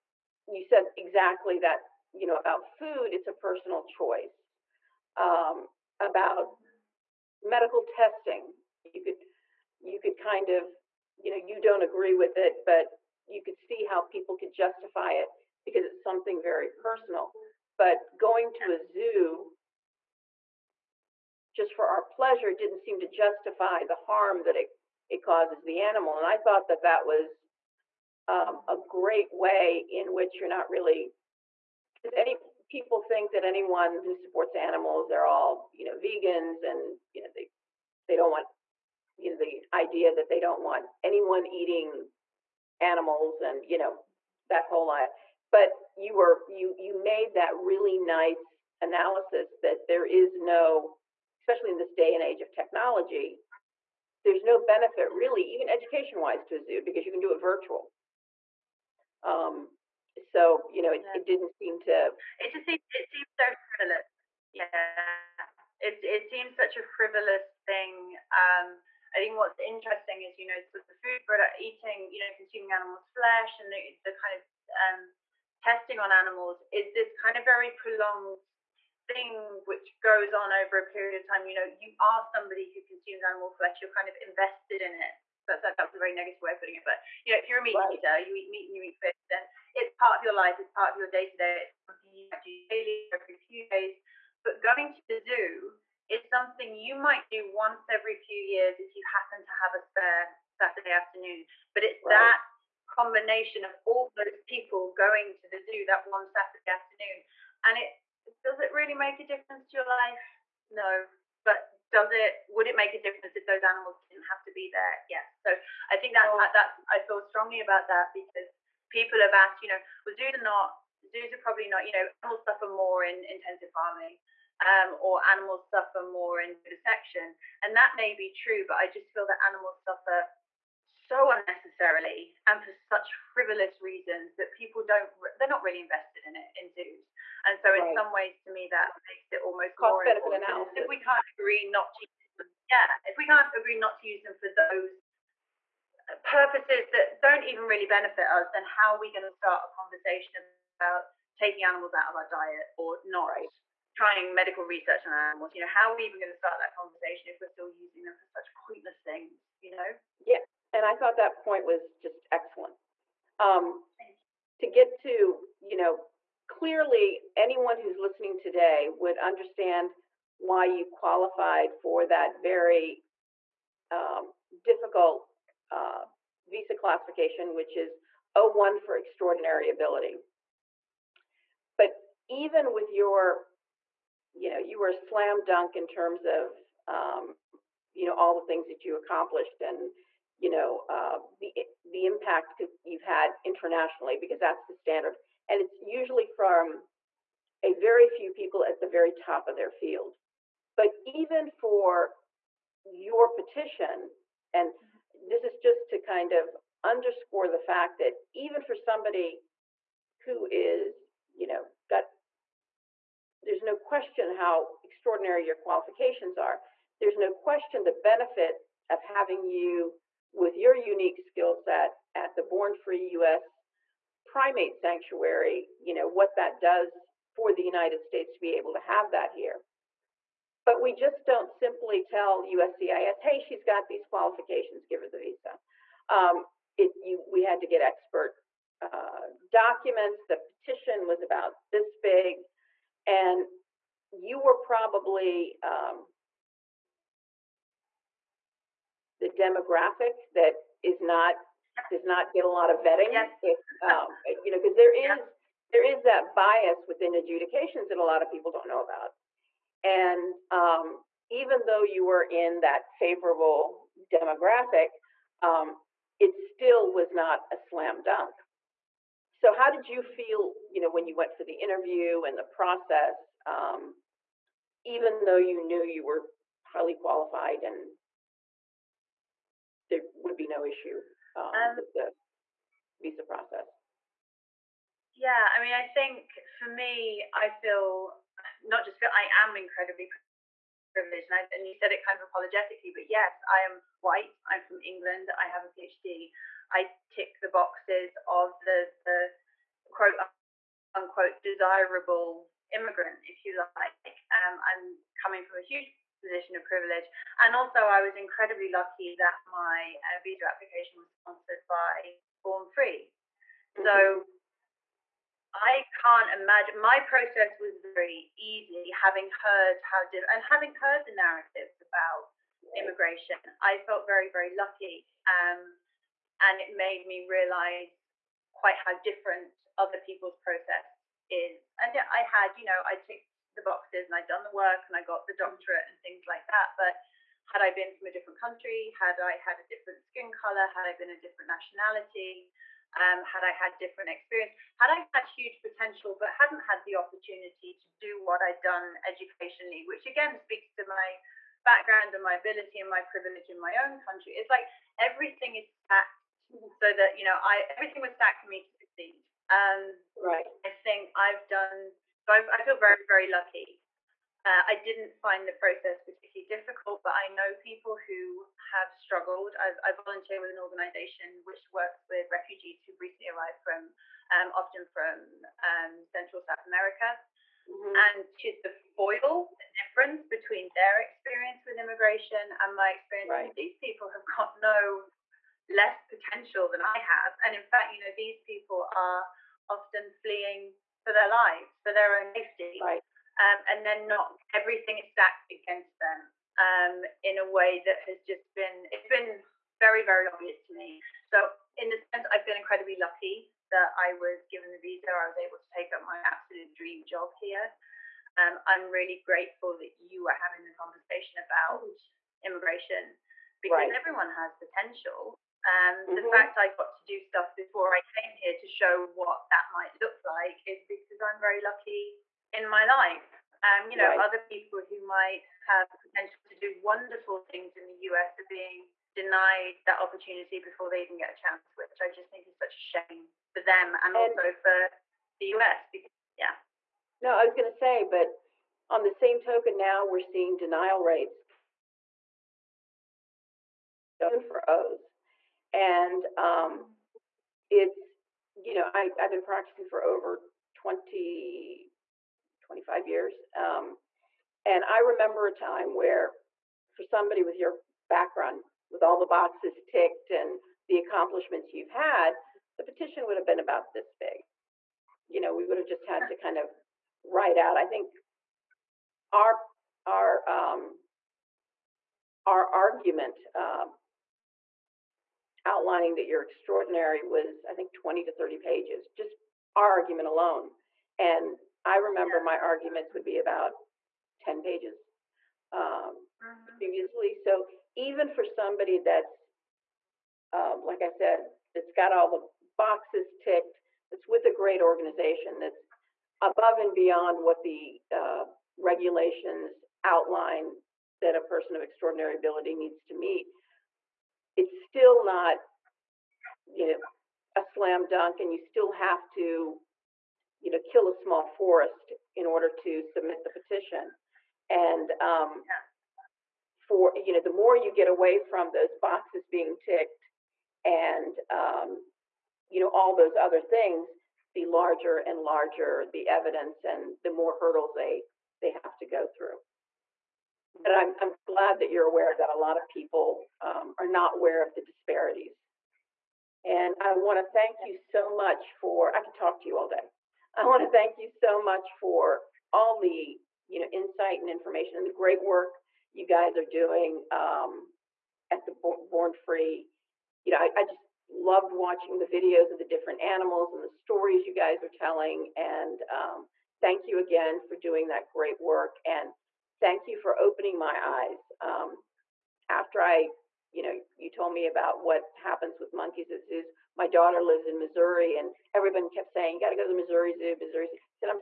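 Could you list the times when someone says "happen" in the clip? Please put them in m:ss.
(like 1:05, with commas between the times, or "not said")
1:39, 9:25.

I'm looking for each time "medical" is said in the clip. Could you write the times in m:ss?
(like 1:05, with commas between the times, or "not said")
0:07, 2:34.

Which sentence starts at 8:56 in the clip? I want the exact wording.
And I want to thank you so much for, I could talk to you all day.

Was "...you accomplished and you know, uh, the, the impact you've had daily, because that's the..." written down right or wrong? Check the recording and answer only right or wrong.
wrong.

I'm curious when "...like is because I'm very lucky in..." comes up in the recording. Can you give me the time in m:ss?
7:00.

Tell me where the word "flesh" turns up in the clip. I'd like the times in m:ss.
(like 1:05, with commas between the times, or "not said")
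1:13, 1:23.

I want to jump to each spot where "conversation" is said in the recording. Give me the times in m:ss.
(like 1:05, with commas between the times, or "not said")
2:29, 2:36, 6:50.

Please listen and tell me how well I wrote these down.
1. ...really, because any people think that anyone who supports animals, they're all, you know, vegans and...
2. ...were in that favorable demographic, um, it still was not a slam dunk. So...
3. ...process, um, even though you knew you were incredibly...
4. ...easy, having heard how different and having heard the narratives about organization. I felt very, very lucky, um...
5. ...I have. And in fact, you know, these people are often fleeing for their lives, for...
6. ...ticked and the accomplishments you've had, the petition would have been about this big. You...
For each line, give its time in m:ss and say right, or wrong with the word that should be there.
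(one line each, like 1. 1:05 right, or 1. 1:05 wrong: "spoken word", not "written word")
1. 0:30 right
2. 4:22 right
3. 4:32 wrong: "highly", not "incredibly"
4. 5:18 wrong: "immigration", not "organization"
5. 6:26 right
6. 7:39 right.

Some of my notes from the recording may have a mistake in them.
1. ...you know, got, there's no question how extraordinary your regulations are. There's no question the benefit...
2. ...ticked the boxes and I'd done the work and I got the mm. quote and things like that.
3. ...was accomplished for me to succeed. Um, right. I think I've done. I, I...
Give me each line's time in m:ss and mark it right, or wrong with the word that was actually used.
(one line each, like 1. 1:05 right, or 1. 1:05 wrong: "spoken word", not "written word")
1. 3:31 wrong: "qualifications", not "regulations"
2. 5:32 wrong: "doctorate", not "quote"
3. 5:58 wrong: "stacked", not "accomplished".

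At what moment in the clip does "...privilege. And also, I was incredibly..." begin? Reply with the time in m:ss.
5:06.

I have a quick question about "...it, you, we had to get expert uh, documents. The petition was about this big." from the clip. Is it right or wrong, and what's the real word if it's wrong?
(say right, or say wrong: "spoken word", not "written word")
right.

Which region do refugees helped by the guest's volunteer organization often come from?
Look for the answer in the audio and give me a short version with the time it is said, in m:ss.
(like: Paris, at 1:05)
Central South America, at 6:16.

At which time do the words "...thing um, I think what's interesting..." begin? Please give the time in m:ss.
1:07.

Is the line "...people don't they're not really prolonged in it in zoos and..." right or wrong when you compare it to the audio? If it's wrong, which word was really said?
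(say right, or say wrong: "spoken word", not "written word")
wrong: "invested", not "prolonged".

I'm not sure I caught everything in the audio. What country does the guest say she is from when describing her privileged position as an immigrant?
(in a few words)
England.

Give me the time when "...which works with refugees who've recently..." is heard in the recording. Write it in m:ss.
6:11.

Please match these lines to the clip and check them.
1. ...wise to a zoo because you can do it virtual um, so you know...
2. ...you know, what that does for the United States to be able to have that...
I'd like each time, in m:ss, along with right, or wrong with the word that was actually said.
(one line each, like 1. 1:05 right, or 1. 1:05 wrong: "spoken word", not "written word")
1. 0:56 right
2. 3:45 right.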